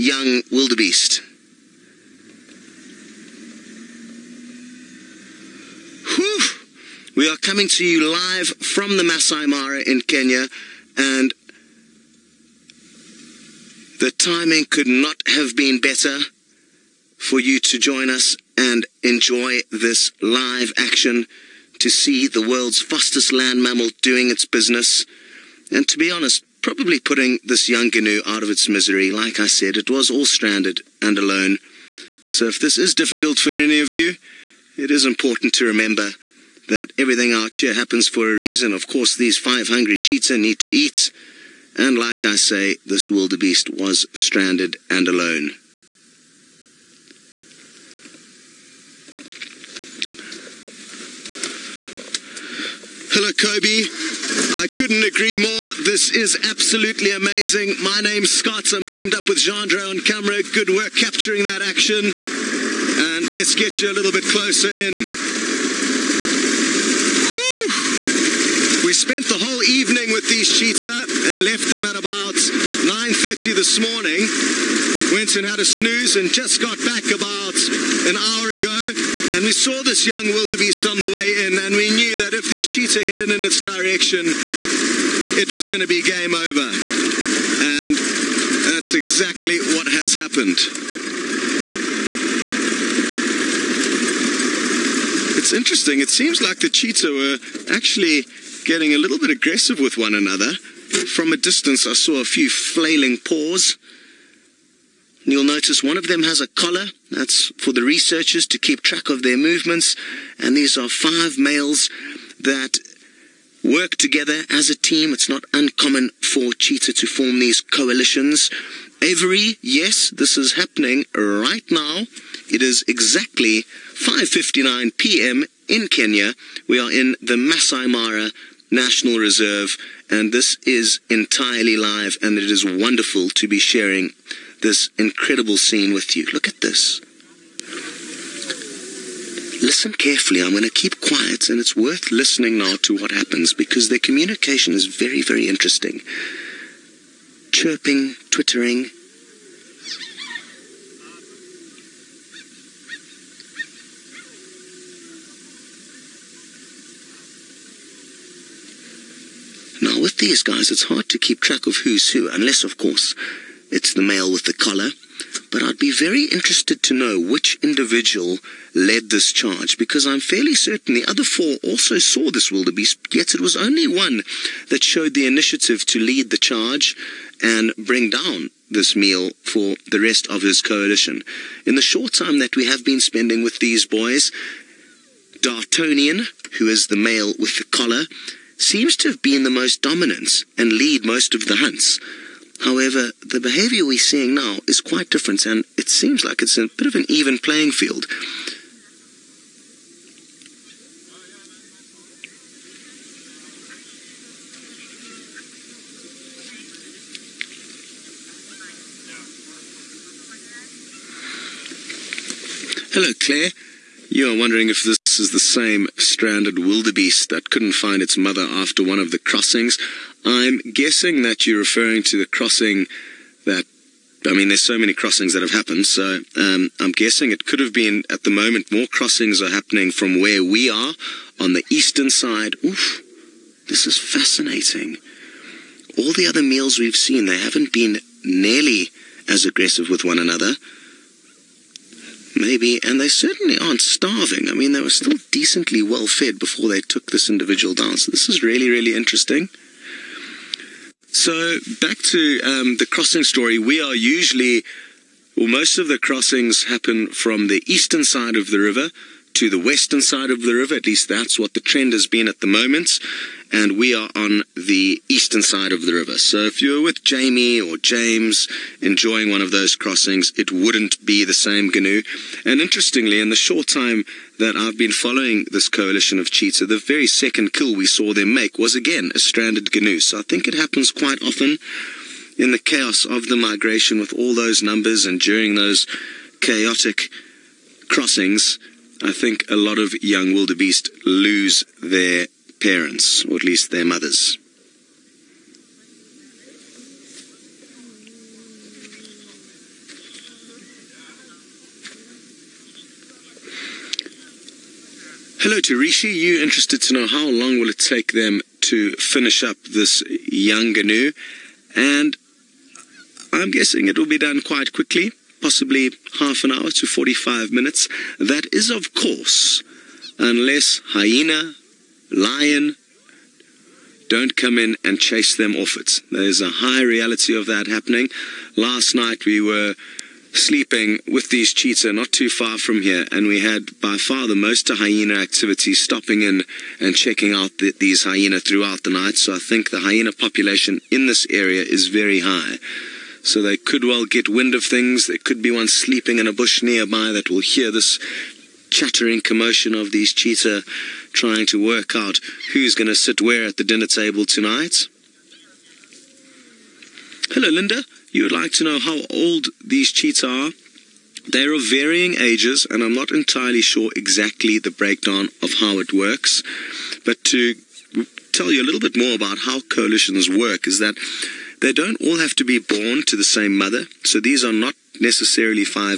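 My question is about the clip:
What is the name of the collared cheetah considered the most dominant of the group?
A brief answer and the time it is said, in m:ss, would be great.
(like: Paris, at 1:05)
Dartonian, at 3:05.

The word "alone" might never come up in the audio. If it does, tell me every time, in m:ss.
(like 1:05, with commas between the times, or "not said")
0:31, 0:45.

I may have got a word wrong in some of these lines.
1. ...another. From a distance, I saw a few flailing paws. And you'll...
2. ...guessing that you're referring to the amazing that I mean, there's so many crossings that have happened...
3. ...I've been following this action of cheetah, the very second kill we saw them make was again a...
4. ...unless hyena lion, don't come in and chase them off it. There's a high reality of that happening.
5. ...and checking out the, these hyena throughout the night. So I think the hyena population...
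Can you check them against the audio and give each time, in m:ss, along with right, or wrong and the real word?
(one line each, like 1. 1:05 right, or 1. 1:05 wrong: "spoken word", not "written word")
1. 1:40 right
2. 3:40 wrong: "crossing", not "amazing"
3. 4:34 wrong: "coalition", not "action"
4. 5:20 right
5. 5:36 right.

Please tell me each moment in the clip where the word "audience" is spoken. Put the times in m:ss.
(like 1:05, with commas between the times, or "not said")
not said.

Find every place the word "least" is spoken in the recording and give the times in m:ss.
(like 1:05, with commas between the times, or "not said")
4:20, 4:53.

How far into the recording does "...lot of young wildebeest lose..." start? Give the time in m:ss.
4:49.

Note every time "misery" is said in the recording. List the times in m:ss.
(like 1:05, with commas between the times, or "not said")
0:28.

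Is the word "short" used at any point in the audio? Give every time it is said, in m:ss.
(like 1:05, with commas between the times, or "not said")
3:01, 4:33.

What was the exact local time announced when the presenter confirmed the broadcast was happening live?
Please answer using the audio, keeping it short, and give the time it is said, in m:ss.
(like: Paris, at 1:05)
5:59 p.m., at 2:04.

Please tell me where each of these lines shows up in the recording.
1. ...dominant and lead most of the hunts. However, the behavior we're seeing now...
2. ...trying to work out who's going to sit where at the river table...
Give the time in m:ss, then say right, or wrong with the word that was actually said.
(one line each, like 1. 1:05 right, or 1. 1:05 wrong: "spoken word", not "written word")
1. 3:09 right
2. 5:51 wrong: "dinner", not "river".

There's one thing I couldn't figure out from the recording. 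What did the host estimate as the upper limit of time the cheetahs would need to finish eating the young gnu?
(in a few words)
45 minutes.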